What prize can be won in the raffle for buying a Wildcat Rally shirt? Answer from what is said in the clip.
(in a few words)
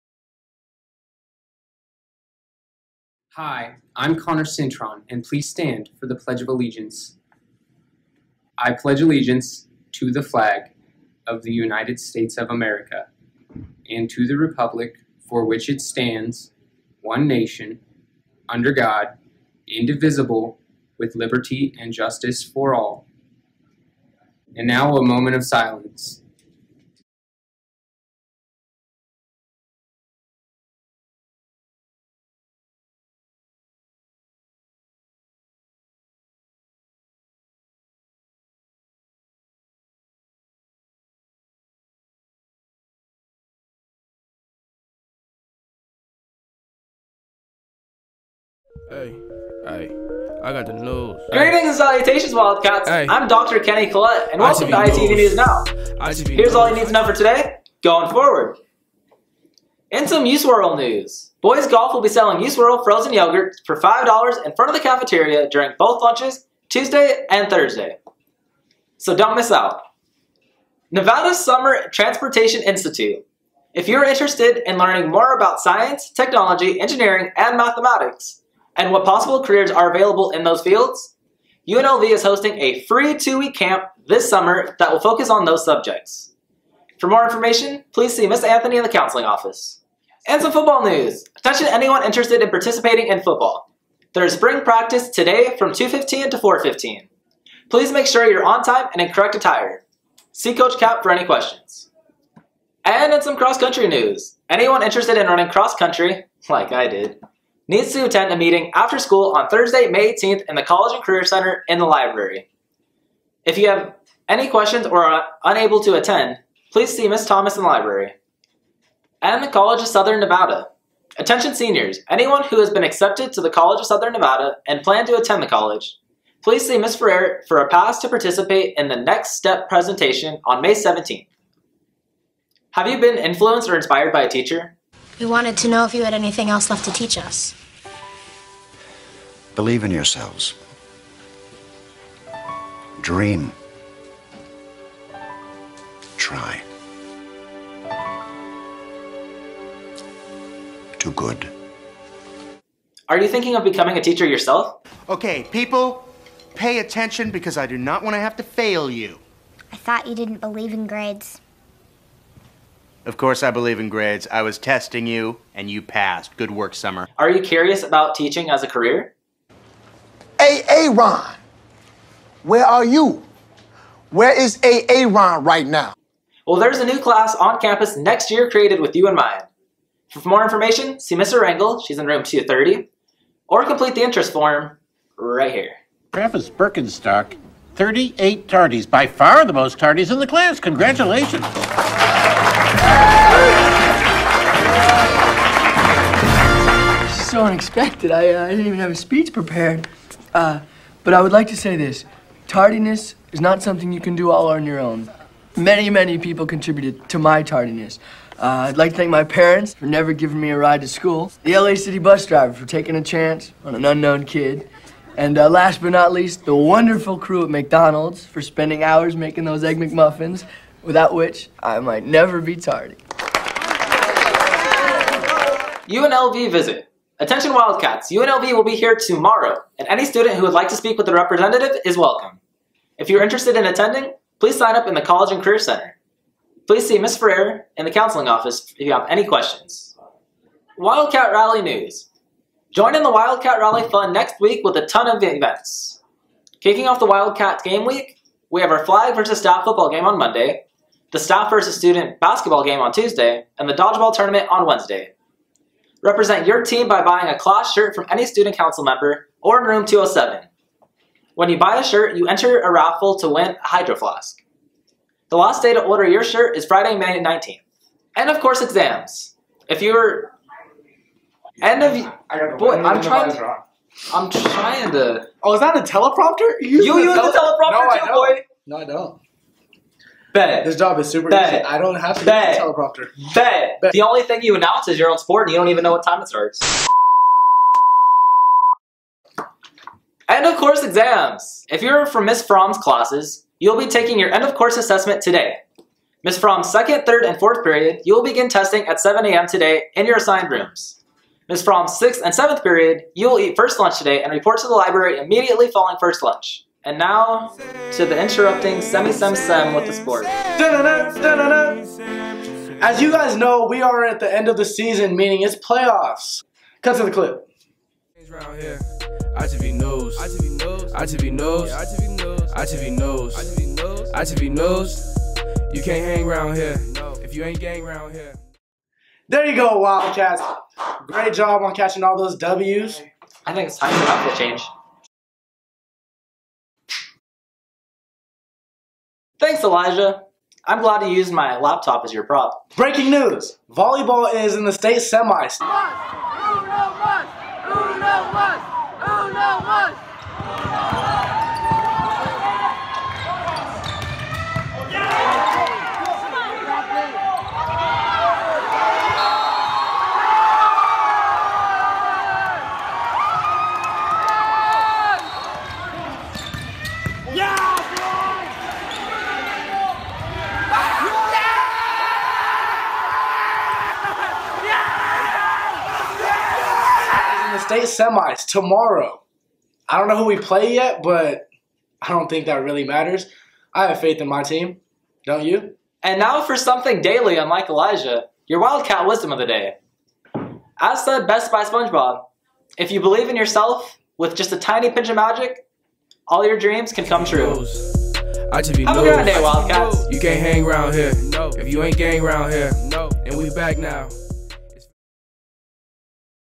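Hydro Flask.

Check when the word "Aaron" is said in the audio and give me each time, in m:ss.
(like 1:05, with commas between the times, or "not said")
2:50, 2:54.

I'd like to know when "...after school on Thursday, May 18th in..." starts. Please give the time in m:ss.
1:48.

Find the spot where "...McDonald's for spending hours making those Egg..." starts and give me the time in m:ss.
3:37.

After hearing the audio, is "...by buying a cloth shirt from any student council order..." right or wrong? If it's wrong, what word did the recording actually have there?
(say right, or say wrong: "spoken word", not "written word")
wrong: "member", not "order".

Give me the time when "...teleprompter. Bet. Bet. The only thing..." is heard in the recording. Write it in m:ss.
4:42.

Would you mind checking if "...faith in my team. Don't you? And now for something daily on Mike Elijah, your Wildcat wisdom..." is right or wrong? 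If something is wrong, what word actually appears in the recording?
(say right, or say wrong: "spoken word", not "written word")
right.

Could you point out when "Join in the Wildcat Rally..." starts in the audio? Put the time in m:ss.
4:02.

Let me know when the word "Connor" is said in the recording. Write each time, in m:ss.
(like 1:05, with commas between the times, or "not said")
0:04.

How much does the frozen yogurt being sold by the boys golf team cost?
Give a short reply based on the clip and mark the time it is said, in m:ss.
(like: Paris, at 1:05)
$5, at 1:03.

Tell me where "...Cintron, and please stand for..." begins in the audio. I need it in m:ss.
0:04.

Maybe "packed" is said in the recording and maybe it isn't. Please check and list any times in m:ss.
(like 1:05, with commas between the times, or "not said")
not said.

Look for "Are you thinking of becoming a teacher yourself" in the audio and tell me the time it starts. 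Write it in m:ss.
2:33.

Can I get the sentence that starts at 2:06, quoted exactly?
Ferrer for a pass to participate in the Next Step presentation on May 17th.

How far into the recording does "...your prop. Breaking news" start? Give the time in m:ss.
5:42.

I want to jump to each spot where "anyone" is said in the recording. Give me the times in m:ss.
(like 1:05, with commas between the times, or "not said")
1:31, 1:44, 2:02.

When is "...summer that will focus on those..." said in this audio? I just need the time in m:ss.
1:24.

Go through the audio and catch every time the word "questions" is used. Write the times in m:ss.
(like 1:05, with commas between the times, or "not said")
1:41, 1:54, 3:59.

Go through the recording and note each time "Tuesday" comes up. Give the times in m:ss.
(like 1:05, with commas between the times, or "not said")
1:06, 4:12.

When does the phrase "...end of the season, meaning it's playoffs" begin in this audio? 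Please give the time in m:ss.
5:14.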